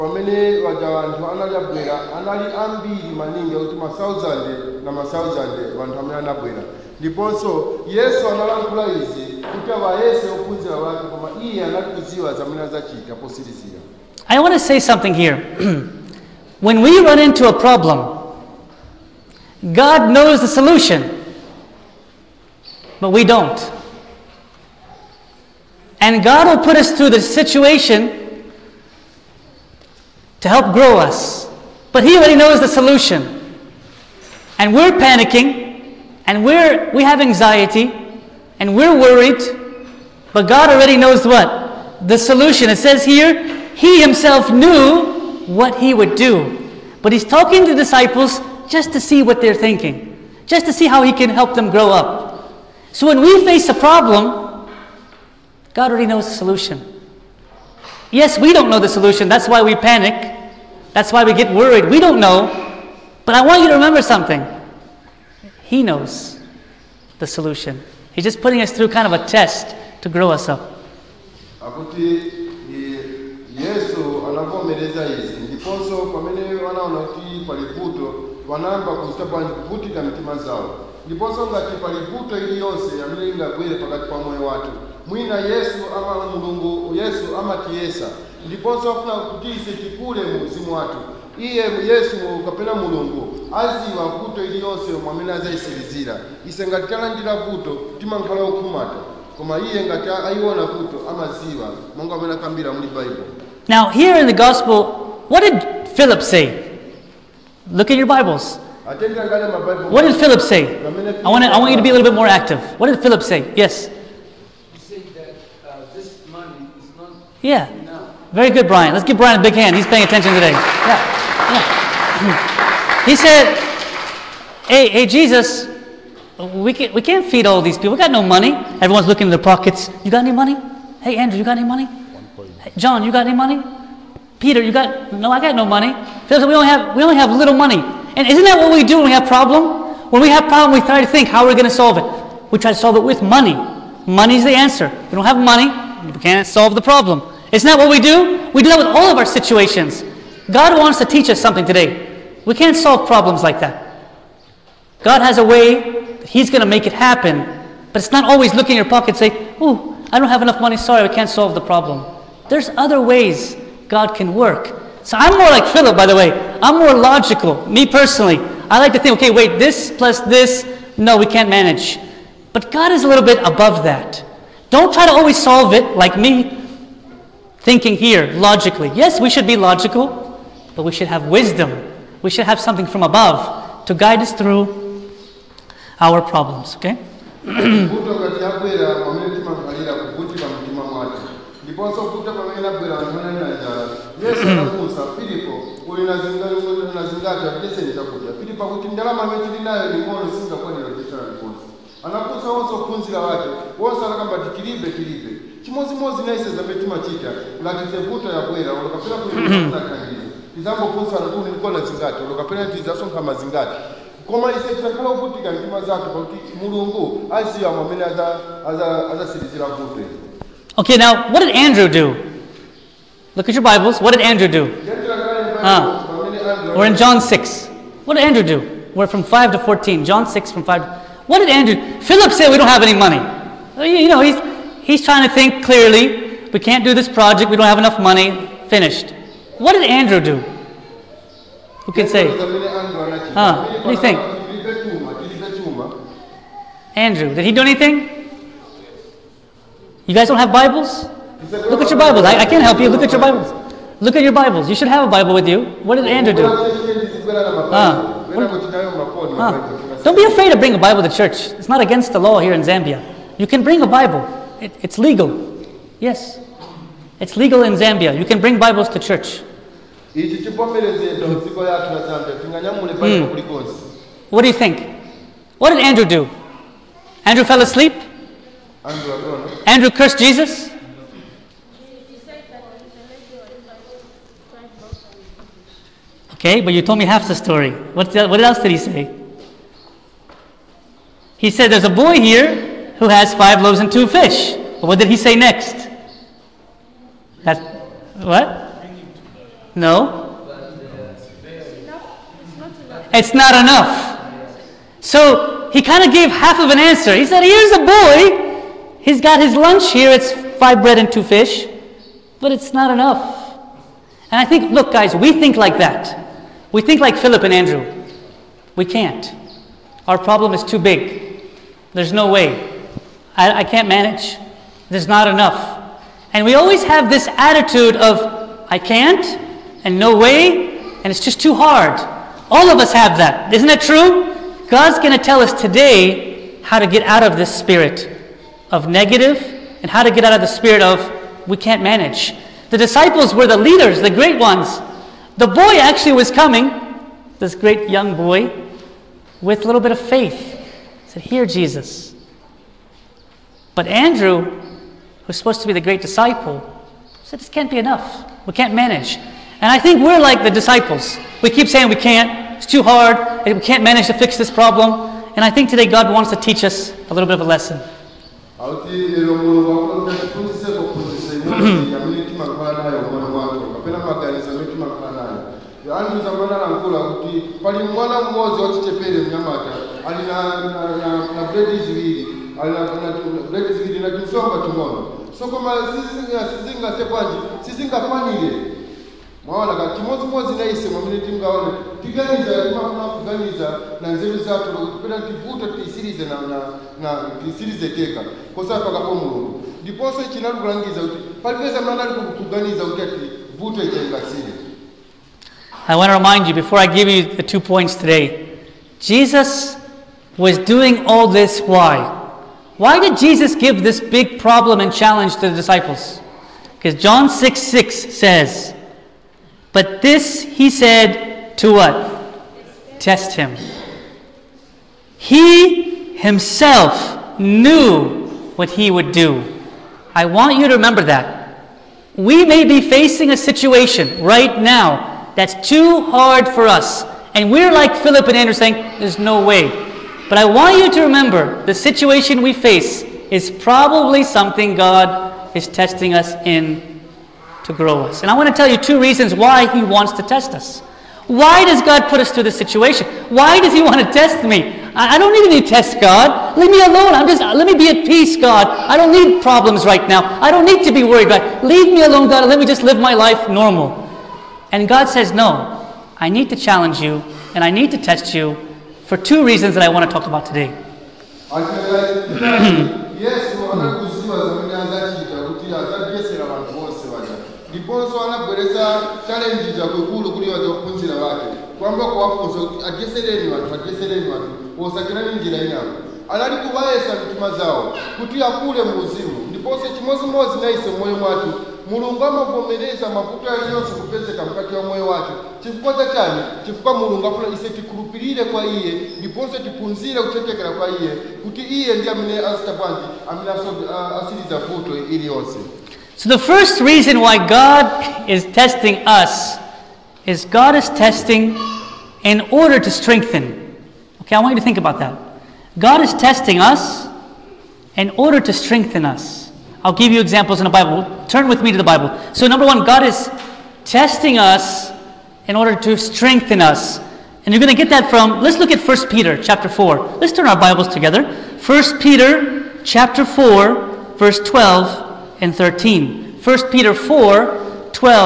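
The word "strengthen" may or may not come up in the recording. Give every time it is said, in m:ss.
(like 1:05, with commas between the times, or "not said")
8:32, 8:38, 8:45.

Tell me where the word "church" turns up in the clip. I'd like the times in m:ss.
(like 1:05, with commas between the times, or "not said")
4:21, 4:28.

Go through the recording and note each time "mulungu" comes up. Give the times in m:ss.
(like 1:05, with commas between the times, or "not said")
1:26, 1:32, 6:39, 8:11, 8:16.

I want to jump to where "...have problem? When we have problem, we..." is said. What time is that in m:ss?
2:19.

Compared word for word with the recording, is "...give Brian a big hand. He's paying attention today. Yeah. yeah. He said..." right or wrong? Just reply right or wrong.
right.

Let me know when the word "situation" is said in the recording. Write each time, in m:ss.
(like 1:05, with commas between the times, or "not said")
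0:27, 2:29, 7:13, 7:21, 7:32.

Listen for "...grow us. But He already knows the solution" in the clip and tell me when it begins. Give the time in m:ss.
0:30.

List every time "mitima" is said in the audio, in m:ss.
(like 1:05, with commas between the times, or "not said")
1:20, 8:07.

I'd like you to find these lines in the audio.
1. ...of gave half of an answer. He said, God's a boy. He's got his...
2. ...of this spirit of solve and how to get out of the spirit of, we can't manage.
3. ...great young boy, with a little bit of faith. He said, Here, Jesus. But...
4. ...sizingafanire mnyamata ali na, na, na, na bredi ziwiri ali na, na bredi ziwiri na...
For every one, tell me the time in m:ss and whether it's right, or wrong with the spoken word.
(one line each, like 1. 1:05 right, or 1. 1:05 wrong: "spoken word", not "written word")
1. 5:06 wrong: "Here", not "God"
2. 5:37 wrong: "negative", not "solve"
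3. 5:47 right
4. 6:18 wrong: "wachichepere", not "sizingafanire".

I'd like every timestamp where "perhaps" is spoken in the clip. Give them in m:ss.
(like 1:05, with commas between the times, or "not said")
not said.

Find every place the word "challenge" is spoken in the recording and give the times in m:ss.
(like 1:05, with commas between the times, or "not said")
6:54, 7:46.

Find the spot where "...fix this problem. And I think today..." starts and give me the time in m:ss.
6:04.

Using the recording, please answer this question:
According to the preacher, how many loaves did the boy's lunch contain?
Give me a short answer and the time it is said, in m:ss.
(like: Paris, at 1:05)
5, at 4:53.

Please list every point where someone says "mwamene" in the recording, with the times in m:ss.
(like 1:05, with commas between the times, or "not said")
6:30.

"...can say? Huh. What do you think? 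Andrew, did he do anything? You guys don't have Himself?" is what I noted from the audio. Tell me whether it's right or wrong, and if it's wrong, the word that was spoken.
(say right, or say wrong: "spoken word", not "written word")
wrong: "Bibles", not "Himself".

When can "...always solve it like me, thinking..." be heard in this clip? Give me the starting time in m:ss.
2:55.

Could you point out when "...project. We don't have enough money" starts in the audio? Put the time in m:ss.
3:57.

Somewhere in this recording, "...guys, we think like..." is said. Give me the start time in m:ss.
5:14.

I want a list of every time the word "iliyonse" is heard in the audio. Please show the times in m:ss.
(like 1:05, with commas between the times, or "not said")
1:34, 8:25.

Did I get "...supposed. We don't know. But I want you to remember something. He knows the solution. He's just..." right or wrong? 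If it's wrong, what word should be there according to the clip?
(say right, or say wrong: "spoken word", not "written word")
wrong: "worried", not "supposed".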